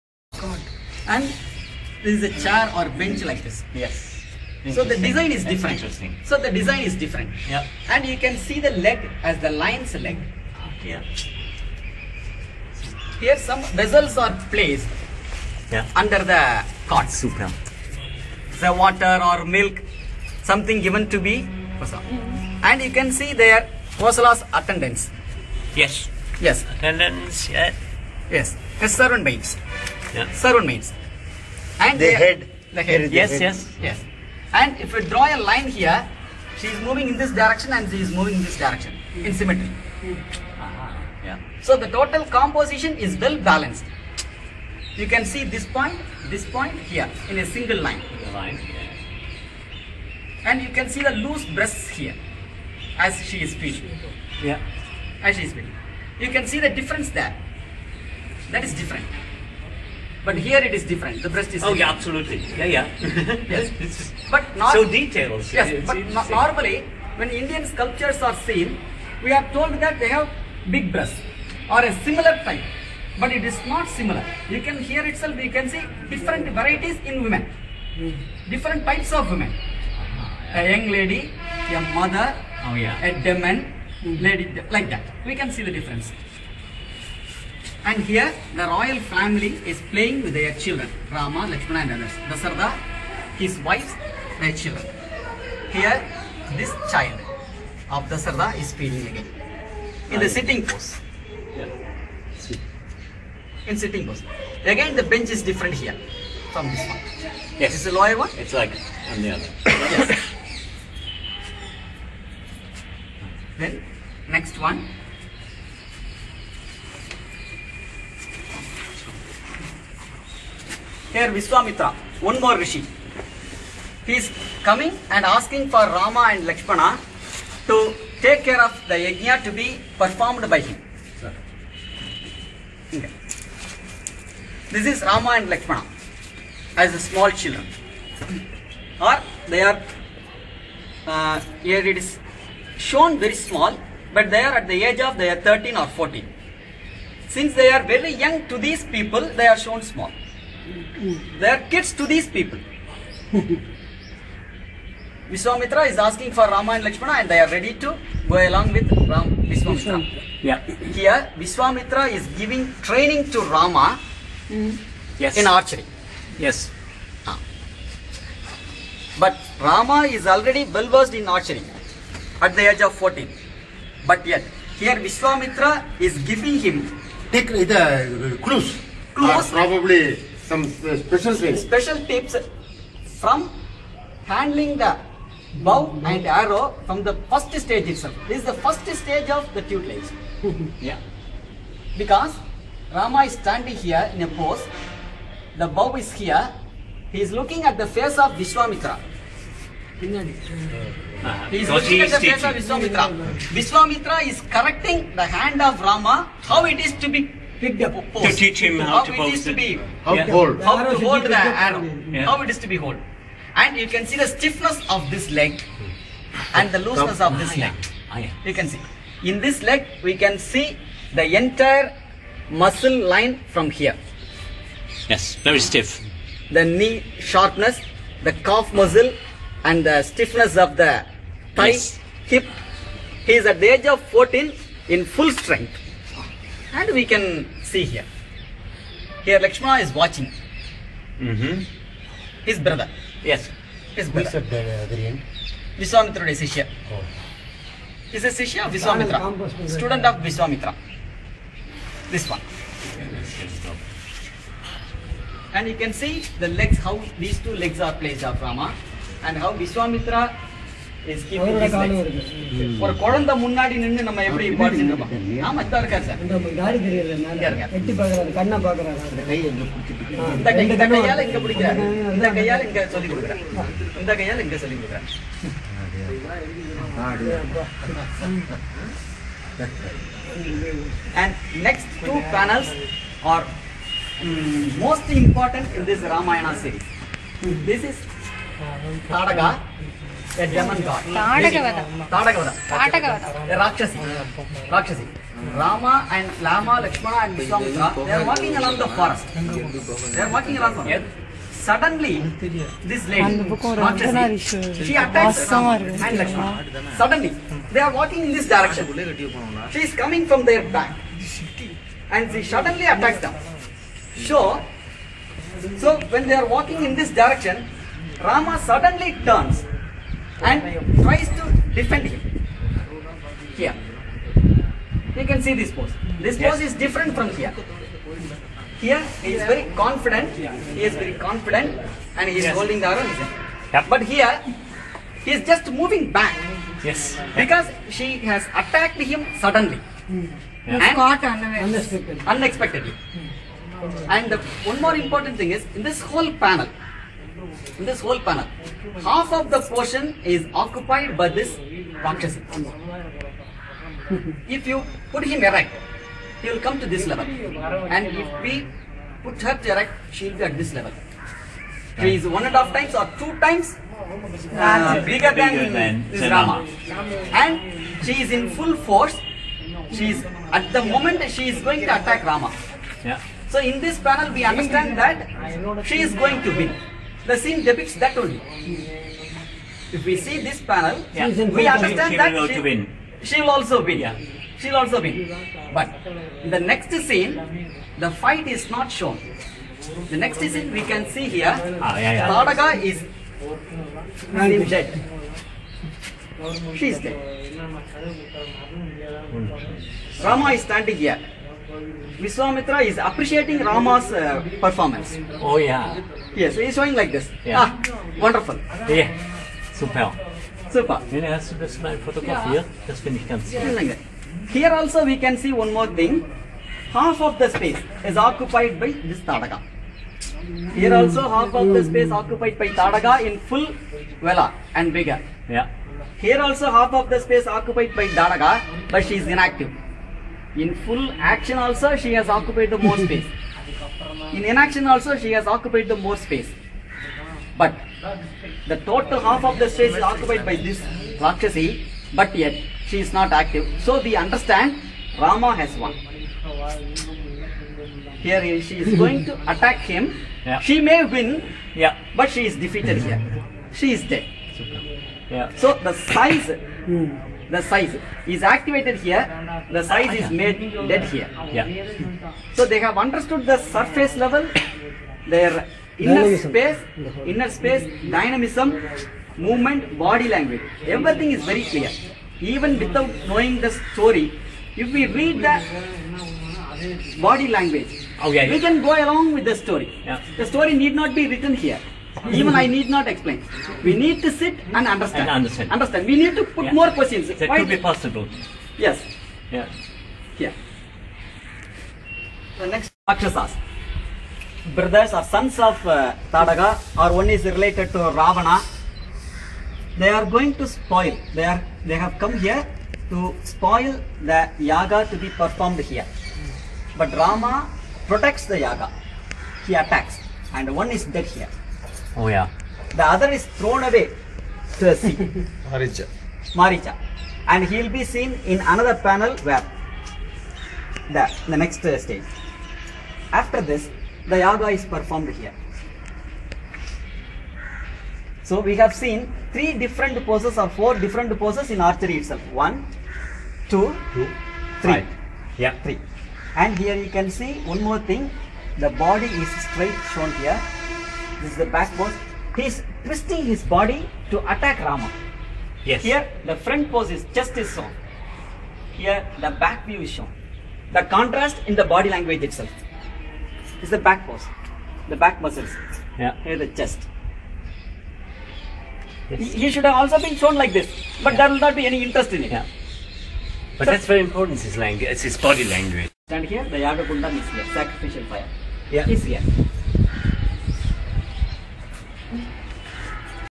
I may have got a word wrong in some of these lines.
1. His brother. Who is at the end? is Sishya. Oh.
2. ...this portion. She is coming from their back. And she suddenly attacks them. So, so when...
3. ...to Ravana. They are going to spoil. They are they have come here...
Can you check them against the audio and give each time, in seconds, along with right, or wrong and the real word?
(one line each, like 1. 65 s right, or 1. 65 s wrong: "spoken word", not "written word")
1. 243 s right
2. 308 s wrong: "direction", not "portion"
3. 497 s right.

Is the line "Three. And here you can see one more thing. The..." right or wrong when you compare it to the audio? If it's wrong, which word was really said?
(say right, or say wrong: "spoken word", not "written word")
right.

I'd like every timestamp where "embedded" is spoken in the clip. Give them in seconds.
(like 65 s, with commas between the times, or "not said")
not said.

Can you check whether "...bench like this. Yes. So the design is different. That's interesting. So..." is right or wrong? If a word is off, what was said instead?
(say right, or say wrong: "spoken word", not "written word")
right.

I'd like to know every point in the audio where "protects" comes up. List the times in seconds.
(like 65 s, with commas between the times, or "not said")
508 s.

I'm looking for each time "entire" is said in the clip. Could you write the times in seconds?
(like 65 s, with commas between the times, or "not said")
221 s.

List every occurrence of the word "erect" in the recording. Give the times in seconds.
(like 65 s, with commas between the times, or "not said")
355 s, 359 s.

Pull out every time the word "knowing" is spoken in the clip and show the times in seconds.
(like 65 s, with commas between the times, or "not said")
473 s.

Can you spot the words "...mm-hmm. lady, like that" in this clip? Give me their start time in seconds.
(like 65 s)
84 s.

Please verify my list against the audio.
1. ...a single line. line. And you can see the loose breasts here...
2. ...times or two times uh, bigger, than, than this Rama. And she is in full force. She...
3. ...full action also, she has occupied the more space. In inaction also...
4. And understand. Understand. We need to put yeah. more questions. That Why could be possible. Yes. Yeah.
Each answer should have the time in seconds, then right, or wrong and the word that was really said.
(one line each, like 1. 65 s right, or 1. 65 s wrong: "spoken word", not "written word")
1. 47 s right
2. 362 s right
3. 430 s right
4. 485 s right.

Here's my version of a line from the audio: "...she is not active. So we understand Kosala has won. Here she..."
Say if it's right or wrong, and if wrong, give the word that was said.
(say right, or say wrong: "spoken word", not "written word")
wrong: "Rama", not "Kosala".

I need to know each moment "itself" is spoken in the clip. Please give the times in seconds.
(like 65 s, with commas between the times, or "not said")
75 s, 187 s, 532 s, 552 s.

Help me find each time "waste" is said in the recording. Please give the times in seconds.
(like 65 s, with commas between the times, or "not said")
not said.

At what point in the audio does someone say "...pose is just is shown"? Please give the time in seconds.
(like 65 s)
546 s.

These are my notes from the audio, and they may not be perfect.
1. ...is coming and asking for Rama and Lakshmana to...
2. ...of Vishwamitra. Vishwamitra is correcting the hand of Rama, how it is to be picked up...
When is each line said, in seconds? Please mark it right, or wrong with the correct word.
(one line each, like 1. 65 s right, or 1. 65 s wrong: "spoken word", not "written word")
1. 124 s right
2. 202 s right.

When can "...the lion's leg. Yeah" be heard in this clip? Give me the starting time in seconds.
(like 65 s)
9 s.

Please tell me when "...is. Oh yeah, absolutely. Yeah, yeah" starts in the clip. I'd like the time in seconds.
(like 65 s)
61 s.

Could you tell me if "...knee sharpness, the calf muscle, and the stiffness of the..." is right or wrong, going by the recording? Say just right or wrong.
right.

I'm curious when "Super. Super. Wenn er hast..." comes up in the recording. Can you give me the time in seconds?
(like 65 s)
409 s.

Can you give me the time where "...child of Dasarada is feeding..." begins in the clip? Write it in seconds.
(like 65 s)
96 s.